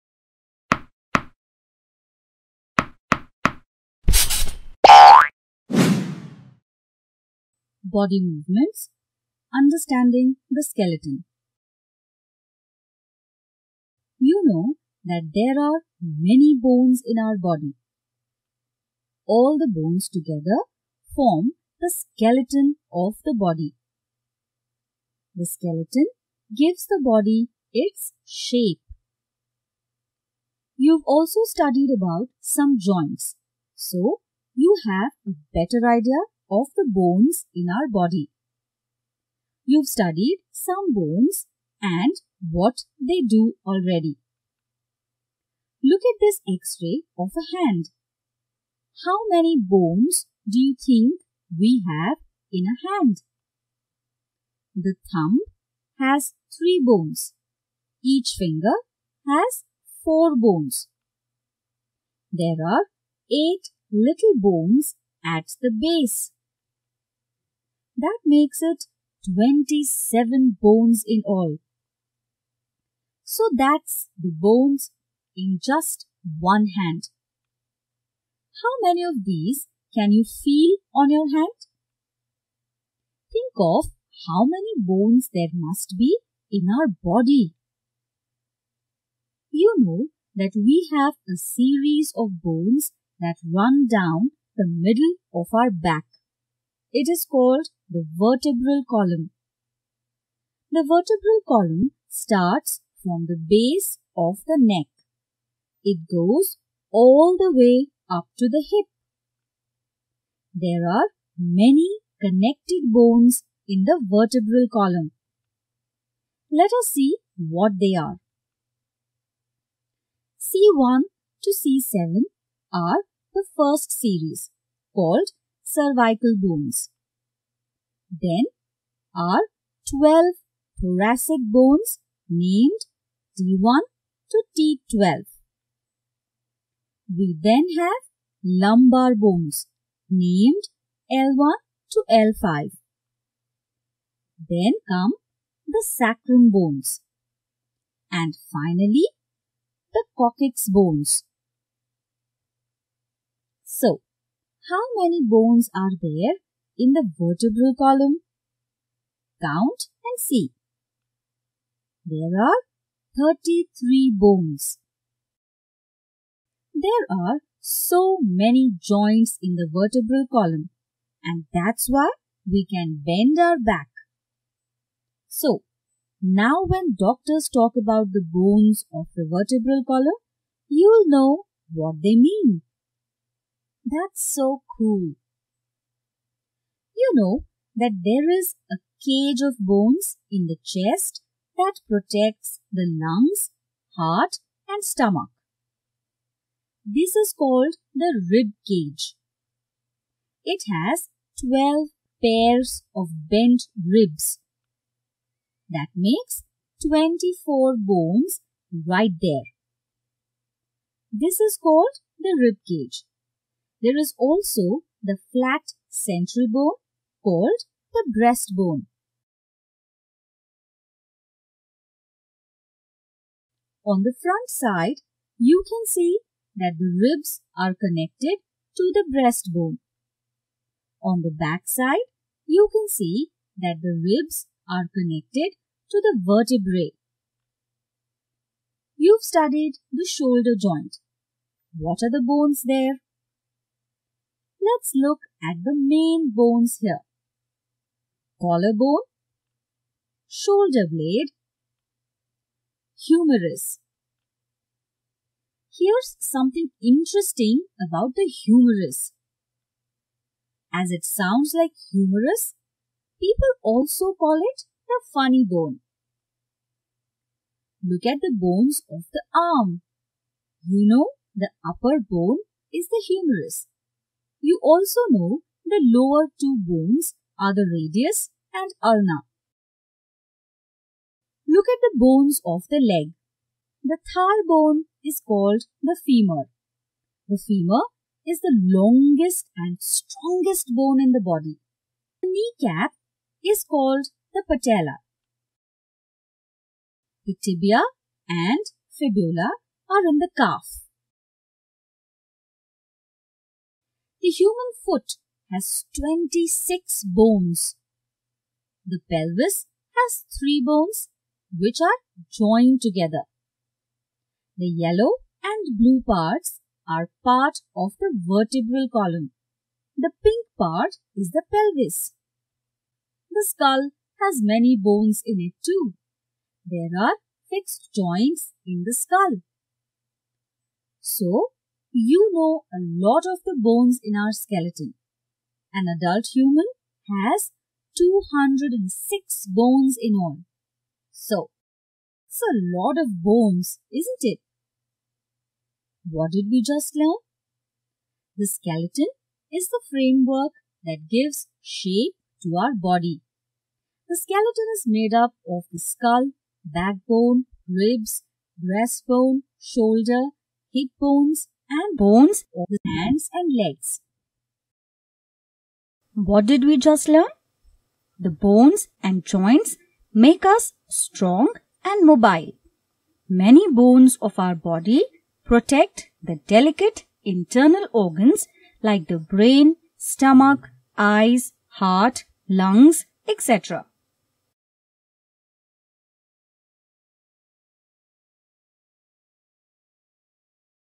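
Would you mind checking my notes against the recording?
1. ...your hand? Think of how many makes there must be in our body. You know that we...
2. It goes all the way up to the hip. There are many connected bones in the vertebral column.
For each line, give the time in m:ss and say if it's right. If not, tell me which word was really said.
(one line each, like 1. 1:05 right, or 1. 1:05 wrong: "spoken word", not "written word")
1. 1:21 wrong: "bones", not "makes"
2. 1:45 right.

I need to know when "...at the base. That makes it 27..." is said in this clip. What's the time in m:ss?
1:05.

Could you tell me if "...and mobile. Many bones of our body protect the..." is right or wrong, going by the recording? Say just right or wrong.
right.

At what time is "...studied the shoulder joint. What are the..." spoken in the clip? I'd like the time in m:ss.
3:59.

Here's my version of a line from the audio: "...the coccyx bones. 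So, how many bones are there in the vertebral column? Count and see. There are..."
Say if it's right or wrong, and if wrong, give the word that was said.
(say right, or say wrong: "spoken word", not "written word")
right.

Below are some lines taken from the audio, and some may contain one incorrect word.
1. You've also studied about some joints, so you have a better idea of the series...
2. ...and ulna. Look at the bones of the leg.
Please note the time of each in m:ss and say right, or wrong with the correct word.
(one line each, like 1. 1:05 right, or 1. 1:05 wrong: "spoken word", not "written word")
1. 0:30 wrong: "bones", not "series"
2. 4:38 right.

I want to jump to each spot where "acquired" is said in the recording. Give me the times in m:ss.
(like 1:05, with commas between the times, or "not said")
not said.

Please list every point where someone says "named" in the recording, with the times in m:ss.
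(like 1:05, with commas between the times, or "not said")
2:12, 2:20.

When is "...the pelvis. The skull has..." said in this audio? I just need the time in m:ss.
5:21.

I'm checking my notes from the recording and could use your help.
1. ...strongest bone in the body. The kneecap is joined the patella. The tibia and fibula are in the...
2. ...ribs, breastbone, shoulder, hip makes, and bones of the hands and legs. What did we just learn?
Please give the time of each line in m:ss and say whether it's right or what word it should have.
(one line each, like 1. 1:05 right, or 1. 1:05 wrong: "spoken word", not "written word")
1. 4:49 wrong: "called", not "joined"
2. 5:57 wrong: "bones", not "makes".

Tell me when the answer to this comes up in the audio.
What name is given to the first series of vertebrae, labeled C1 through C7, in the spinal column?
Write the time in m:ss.
2:05.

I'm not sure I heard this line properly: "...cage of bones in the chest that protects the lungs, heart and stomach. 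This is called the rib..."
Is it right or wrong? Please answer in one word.
right.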